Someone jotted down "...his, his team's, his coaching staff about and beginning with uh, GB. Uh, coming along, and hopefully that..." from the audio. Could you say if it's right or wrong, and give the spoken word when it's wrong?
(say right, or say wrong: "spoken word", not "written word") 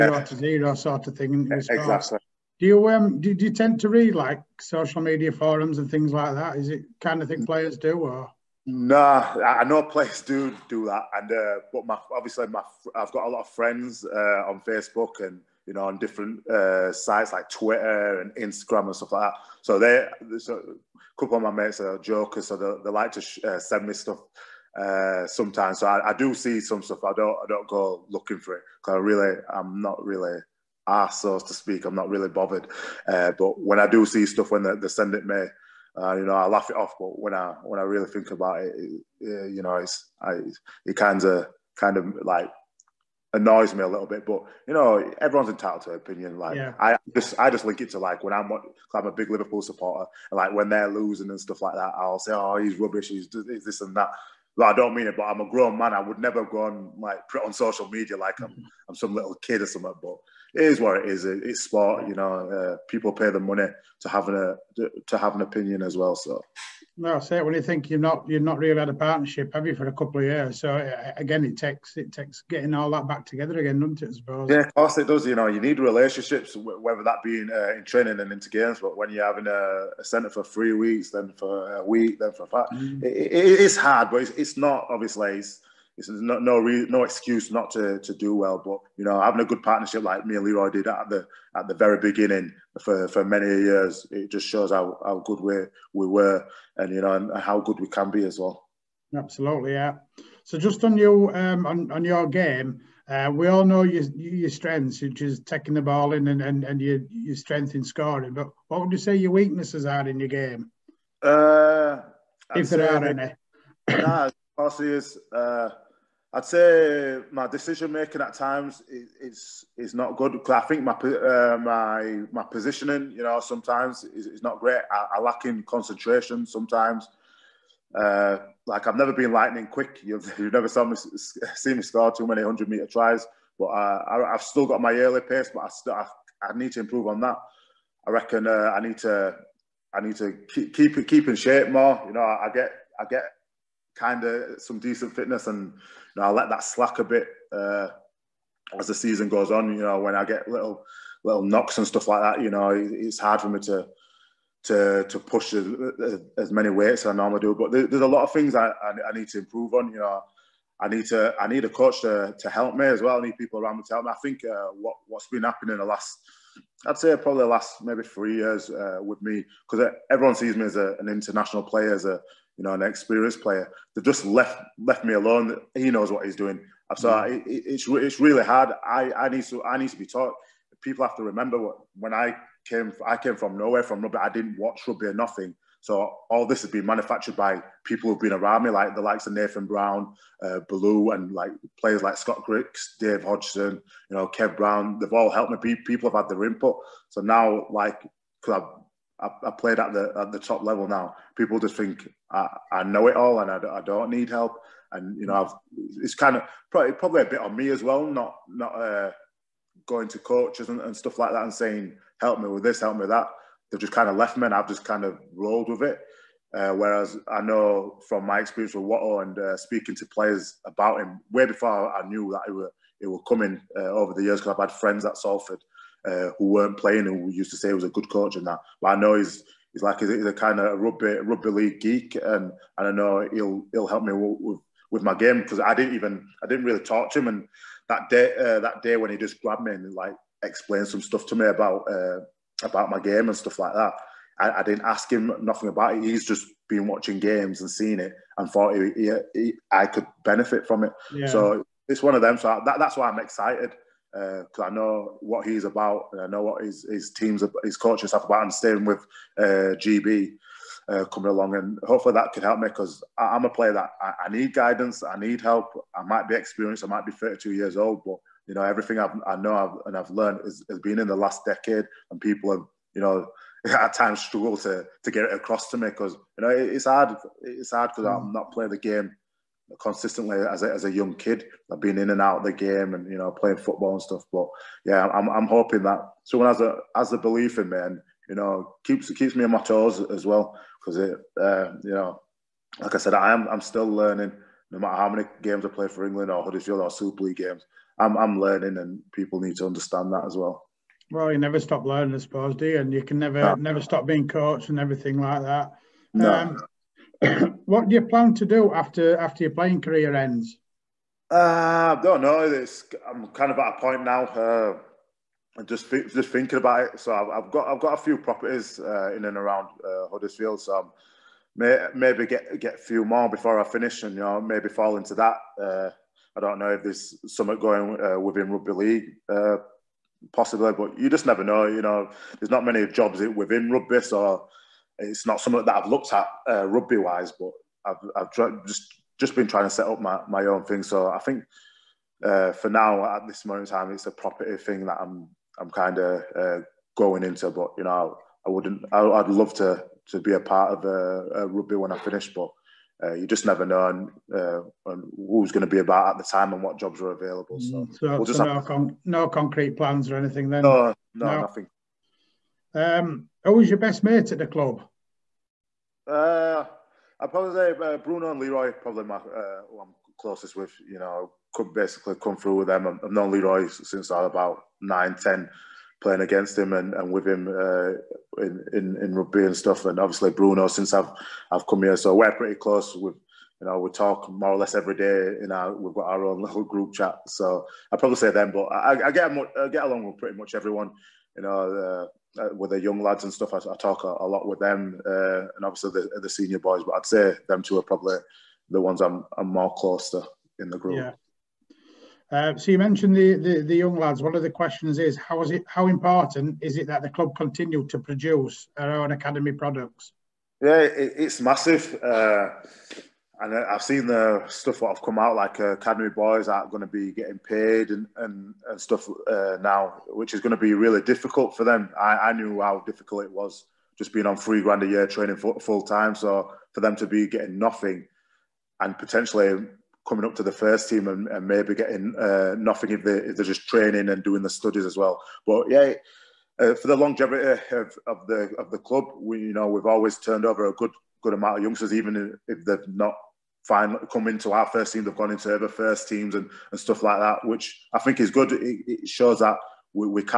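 wrong: "staying", not "beginning".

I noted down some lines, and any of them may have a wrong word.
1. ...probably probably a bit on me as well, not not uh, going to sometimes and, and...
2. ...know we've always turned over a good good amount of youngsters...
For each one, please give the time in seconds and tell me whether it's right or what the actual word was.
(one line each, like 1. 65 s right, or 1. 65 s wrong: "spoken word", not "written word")
1. 206 s wrong: "coaches", not "sometimes"
2. 439 s right.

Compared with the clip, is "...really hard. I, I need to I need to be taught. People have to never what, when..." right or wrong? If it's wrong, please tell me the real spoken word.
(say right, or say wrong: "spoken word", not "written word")
wrong: "remember", not "never".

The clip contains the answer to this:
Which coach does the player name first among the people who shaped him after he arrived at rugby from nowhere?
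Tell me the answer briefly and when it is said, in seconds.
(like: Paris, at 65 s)
Nathan Brown, at 189 s.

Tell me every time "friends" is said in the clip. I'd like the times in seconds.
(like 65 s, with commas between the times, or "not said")
13 s, 224 s.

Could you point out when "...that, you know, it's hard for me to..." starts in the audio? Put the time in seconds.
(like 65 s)
152 s.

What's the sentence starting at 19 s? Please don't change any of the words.
So they so a couple of my mates are jokers, so they, they like to sh- uh, send me stuff uh, sometimes.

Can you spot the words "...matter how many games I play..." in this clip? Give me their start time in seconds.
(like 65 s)
294 s.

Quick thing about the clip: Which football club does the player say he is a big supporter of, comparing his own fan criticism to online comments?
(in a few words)
Liverpool.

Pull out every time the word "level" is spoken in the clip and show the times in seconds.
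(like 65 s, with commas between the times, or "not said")
200 s.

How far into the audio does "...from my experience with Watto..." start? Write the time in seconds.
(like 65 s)
218 s.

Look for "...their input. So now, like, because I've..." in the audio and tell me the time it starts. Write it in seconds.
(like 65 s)
196 s.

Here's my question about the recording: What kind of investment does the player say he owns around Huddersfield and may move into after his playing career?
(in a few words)
Properties.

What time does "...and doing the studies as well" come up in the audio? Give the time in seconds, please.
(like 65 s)
434 s.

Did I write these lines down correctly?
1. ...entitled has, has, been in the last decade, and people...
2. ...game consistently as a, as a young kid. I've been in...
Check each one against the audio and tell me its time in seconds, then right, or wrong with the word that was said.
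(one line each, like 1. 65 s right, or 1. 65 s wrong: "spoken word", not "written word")
1. 270 s wrong: "learned", not "entitled"
2. 278 s right.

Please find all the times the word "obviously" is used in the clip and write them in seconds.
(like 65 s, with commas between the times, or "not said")
12 s, 84 s, 379 s, 395 s.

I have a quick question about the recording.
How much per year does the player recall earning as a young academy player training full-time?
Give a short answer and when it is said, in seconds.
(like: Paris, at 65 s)
3 grand, at 424 s.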